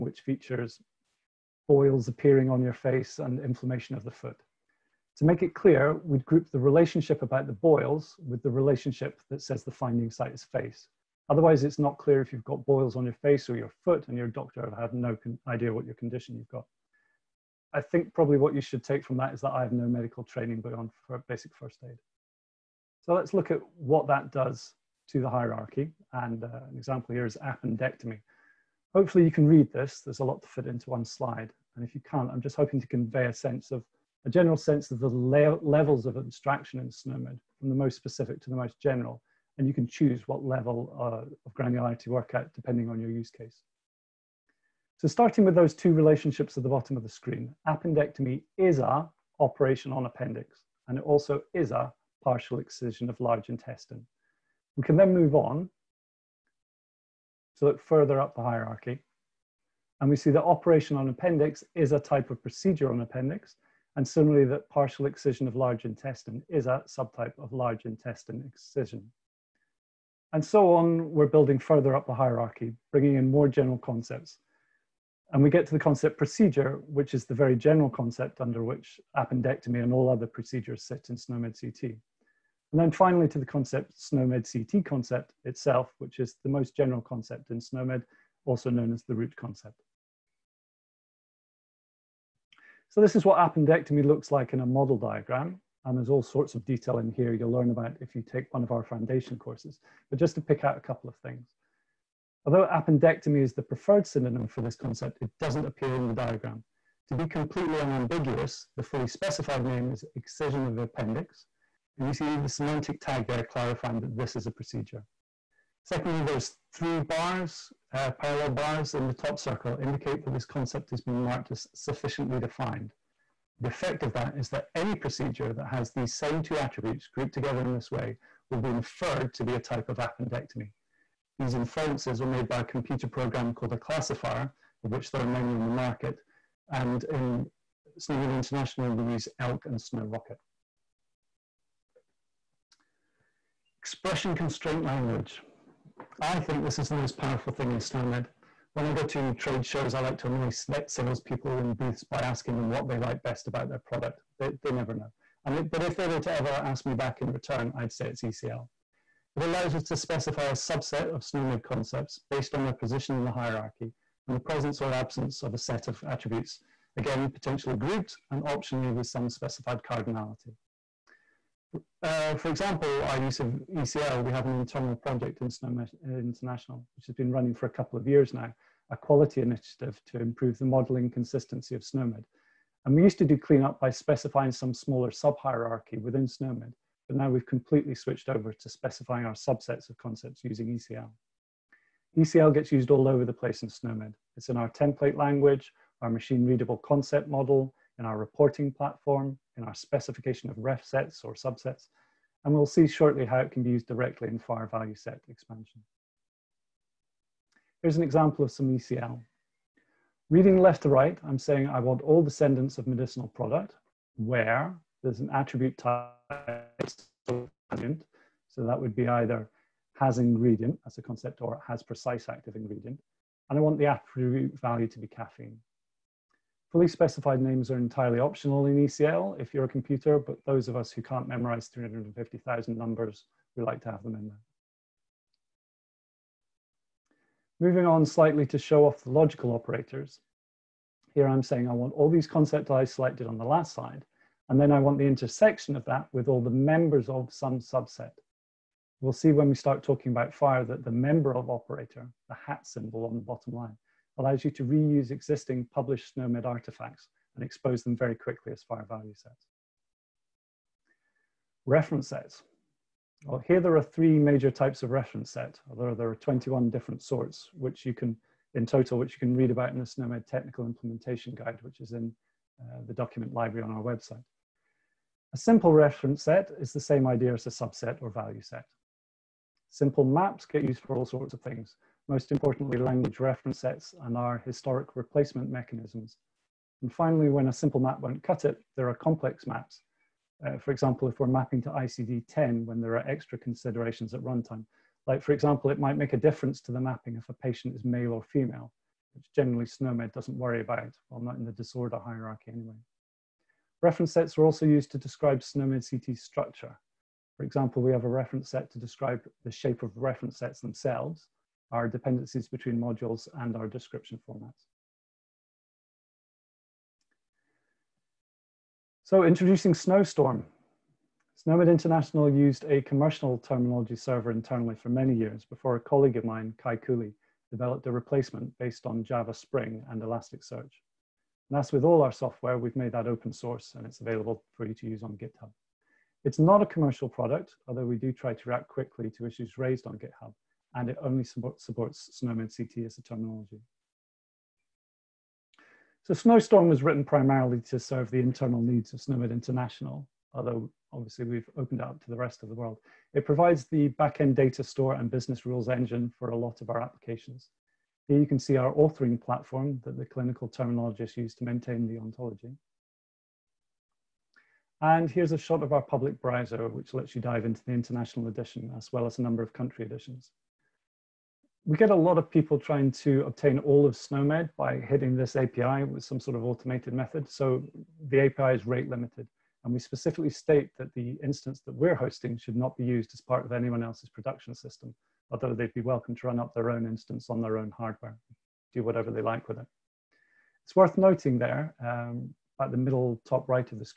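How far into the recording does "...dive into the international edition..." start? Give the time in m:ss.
6:07.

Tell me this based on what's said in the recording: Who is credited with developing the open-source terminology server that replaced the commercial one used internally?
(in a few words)
Kai Kewley.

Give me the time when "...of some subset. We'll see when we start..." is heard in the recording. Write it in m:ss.
4:07.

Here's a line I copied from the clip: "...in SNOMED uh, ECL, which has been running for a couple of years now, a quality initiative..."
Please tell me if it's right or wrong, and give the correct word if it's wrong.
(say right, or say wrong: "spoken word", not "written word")
wrong: "International", not "ECL".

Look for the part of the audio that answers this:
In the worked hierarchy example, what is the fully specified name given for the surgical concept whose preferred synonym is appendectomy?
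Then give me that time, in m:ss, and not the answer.
1:50.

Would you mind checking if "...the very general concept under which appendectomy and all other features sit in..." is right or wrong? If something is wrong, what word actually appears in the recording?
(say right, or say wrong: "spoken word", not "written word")
wrong: "procedures", not "features".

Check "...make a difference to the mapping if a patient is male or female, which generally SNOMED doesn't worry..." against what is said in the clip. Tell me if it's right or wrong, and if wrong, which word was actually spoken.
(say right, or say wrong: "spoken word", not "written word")
right.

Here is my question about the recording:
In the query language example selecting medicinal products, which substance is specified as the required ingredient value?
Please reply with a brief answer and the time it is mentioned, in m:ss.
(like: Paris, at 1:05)
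caffeine, at 3:45.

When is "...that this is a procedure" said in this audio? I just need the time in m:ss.
1:54.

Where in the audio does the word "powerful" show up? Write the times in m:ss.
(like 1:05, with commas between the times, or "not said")
2:27.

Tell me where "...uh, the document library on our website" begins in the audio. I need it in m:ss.
4:32.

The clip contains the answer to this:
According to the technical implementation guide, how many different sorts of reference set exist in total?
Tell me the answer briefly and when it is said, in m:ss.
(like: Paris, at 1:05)
21, at 4:26.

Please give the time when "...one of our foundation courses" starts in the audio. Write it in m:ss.
1:38.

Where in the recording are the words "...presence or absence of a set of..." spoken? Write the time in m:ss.
2:44.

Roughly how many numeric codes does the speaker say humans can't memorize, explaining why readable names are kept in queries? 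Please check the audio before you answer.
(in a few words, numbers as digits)
350,000.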